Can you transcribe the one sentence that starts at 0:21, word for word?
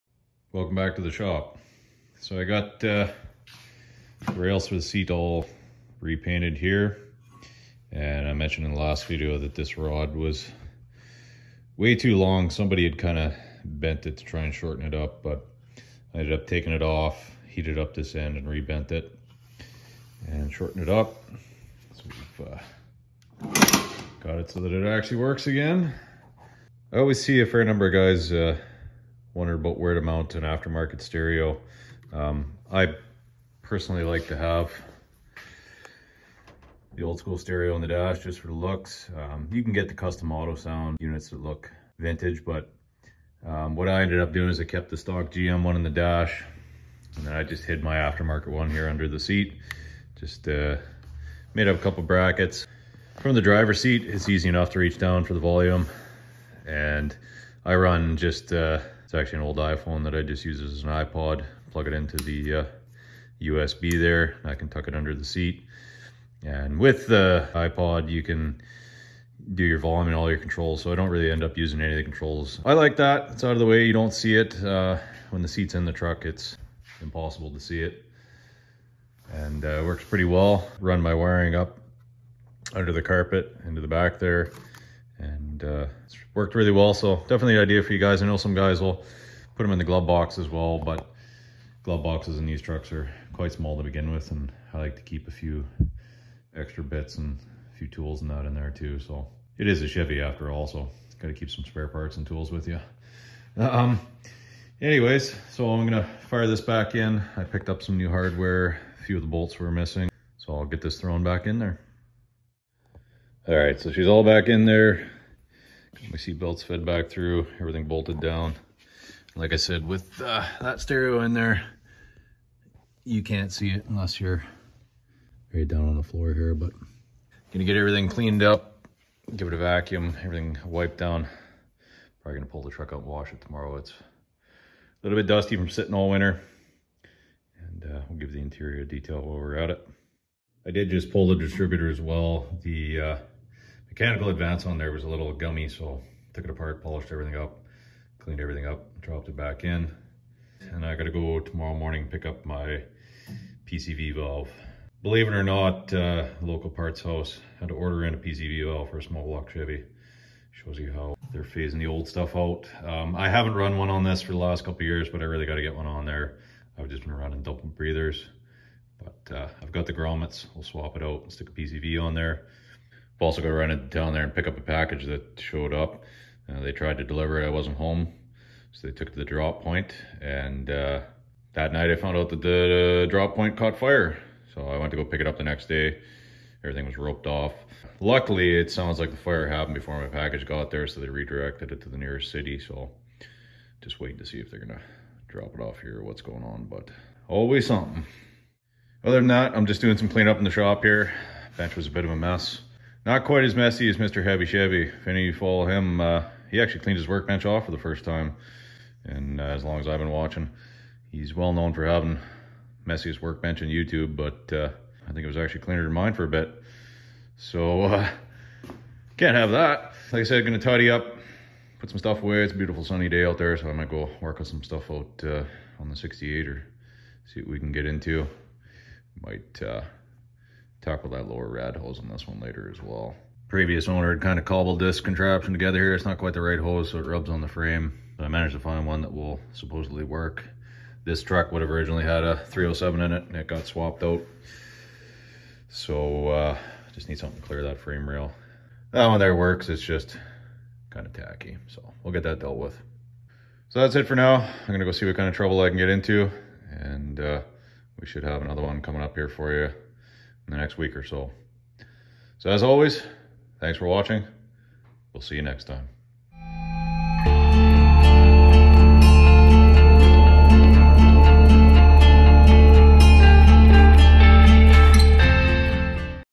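So we've uh, got it so that it actually works again.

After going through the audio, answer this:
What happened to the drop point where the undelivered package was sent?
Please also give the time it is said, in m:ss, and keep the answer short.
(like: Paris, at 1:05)
Caught fire, at 3:03.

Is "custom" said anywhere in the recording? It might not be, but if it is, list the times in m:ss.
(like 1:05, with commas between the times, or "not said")
0:39.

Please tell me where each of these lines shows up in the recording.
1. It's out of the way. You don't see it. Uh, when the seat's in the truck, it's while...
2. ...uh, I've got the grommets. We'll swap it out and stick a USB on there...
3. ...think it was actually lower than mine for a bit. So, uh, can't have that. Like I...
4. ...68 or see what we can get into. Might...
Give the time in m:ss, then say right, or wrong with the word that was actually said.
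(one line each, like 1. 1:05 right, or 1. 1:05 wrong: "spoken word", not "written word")
1. 1:13 wrong: "impossible", not "while"
2. 2:49 wrong: "PCV", not "USB"
3. 3:35 wrong: "cleaner", not "lower"
4. 3:45 right.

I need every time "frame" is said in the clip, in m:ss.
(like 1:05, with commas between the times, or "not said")
3:57, 4:07.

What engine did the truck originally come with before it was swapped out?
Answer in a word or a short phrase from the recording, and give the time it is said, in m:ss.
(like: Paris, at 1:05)
307, at 4:02.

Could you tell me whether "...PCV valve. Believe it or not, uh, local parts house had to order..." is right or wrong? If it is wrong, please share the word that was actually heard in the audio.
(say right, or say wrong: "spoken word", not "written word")
right.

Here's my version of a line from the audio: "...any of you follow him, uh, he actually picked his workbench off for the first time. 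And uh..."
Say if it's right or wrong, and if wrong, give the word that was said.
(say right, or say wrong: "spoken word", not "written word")
wrong: "cleaned", not "picked".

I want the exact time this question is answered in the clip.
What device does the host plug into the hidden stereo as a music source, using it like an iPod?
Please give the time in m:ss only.
0:59.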